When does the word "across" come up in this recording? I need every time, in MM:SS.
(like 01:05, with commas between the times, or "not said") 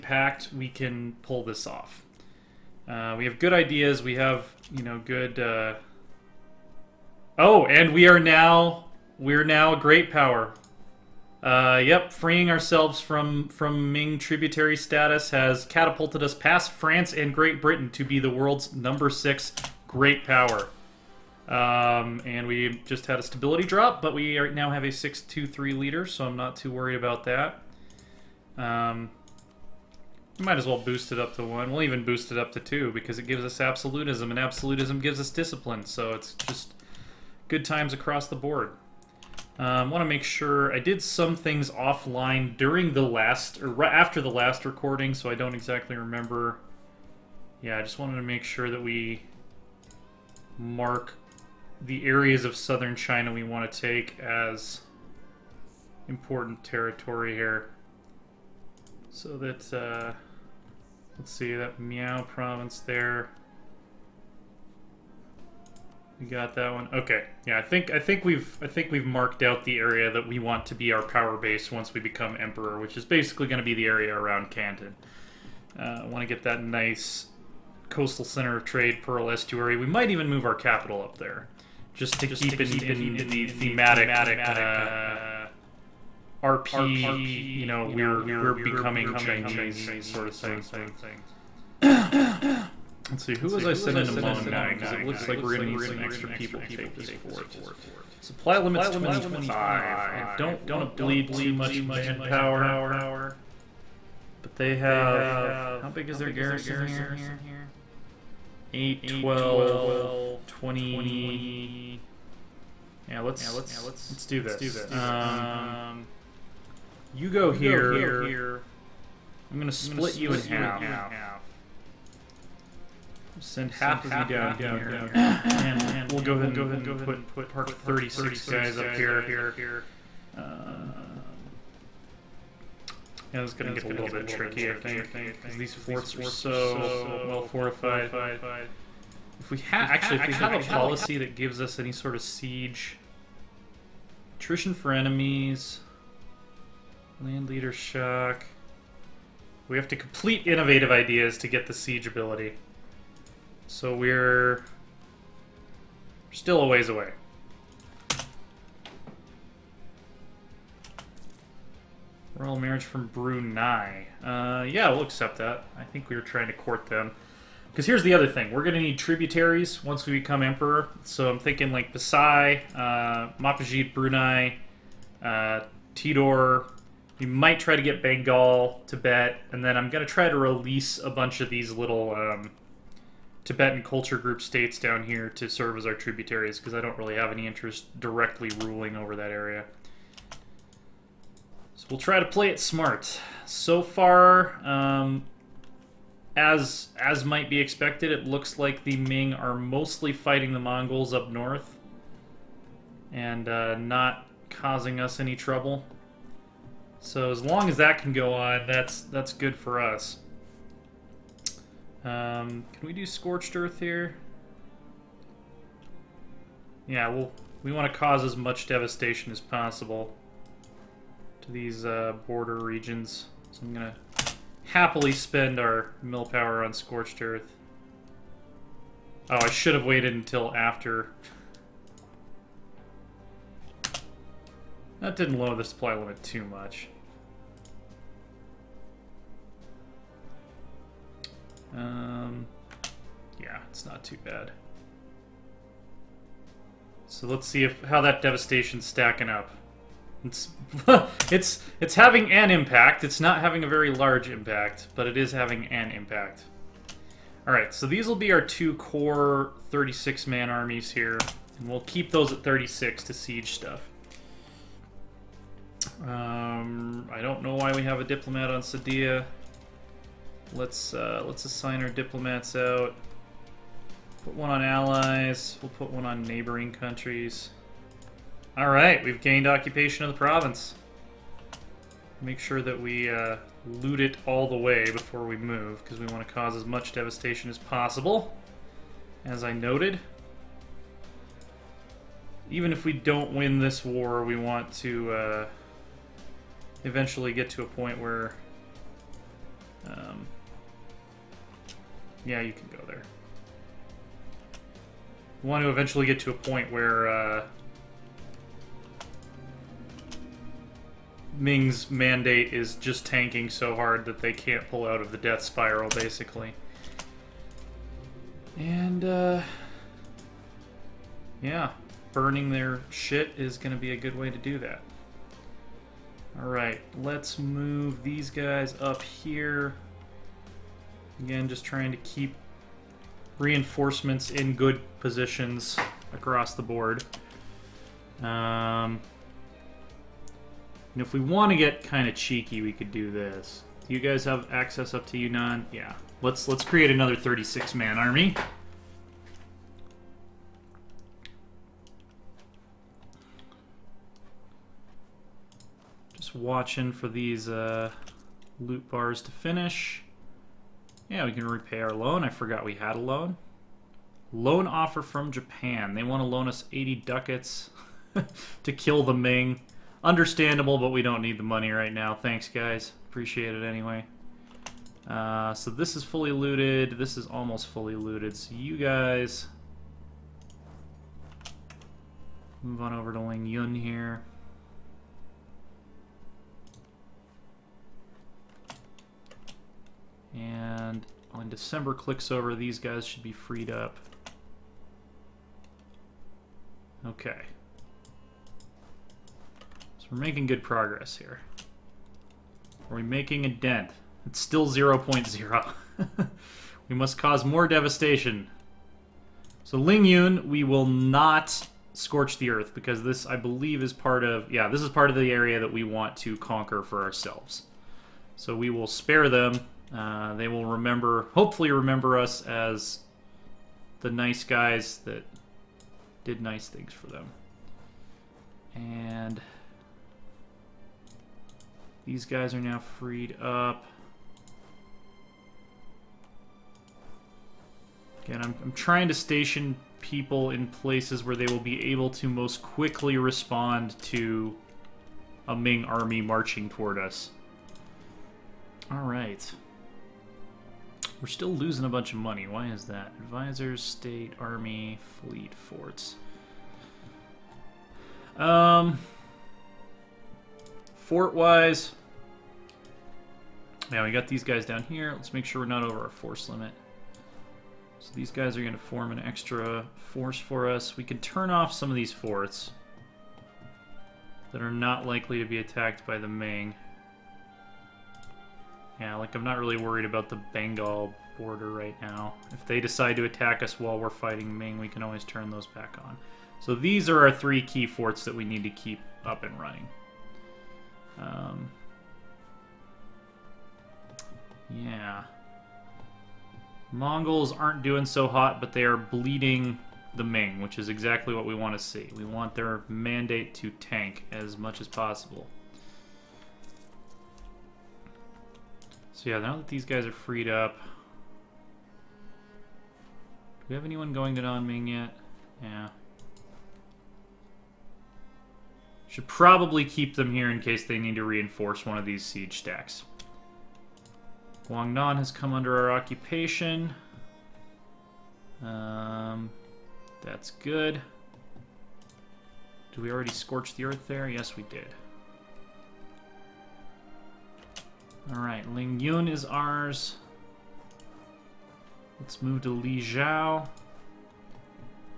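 00:37, 05:36.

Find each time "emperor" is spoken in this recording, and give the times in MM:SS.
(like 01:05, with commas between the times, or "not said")
01:12, 02:50.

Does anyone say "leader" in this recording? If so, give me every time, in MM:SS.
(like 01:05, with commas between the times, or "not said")
00:25, 02:27.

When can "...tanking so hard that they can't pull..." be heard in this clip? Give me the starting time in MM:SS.
05:13.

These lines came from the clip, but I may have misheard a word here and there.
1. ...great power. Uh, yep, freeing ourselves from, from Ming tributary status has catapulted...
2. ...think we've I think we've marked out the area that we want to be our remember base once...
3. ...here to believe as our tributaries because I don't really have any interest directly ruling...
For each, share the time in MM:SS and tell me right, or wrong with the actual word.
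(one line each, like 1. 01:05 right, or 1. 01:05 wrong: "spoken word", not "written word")
1. 00:09 right
2. 01:07 wrong: "power", not "remember"
3. 03:05 wrong: "serve", not "believe".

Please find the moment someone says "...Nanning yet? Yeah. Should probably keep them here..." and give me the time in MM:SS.
08:34.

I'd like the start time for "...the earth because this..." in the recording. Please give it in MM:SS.
06:52.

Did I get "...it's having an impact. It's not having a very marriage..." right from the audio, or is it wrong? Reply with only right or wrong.
wrong.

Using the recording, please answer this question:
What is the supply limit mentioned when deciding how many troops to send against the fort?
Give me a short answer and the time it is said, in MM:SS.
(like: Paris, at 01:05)
25, at 01:38.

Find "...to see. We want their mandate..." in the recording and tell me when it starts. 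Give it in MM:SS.
08:21.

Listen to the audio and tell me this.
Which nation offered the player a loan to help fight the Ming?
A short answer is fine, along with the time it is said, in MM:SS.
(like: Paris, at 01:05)
Japan, at 06:05.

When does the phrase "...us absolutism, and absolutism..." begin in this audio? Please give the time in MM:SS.
00:33.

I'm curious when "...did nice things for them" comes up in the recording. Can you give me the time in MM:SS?
07:06.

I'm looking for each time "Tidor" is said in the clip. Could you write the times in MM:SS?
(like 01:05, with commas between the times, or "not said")
02:55.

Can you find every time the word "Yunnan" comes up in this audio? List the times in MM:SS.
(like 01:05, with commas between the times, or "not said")
05:45.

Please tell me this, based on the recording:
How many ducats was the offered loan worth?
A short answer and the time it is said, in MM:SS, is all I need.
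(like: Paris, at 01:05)
80, at 06:06.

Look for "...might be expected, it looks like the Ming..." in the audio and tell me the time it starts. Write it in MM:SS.
03:17.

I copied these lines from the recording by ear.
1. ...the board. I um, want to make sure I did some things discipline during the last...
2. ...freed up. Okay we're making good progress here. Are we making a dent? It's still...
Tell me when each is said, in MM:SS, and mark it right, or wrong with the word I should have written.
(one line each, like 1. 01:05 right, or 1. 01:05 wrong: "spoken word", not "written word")
1. 00:38 wrong: "offline", not "discipline"
2. 06:33 right.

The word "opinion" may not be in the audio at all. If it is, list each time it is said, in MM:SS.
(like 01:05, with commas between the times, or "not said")
not said.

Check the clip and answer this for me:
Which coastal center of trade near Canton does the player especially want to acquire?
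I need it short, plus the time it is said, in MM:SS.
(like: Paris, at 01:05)
Pearl Estuary, at 01:19.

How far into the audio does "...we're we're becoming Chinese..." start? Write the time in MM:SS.
01:27.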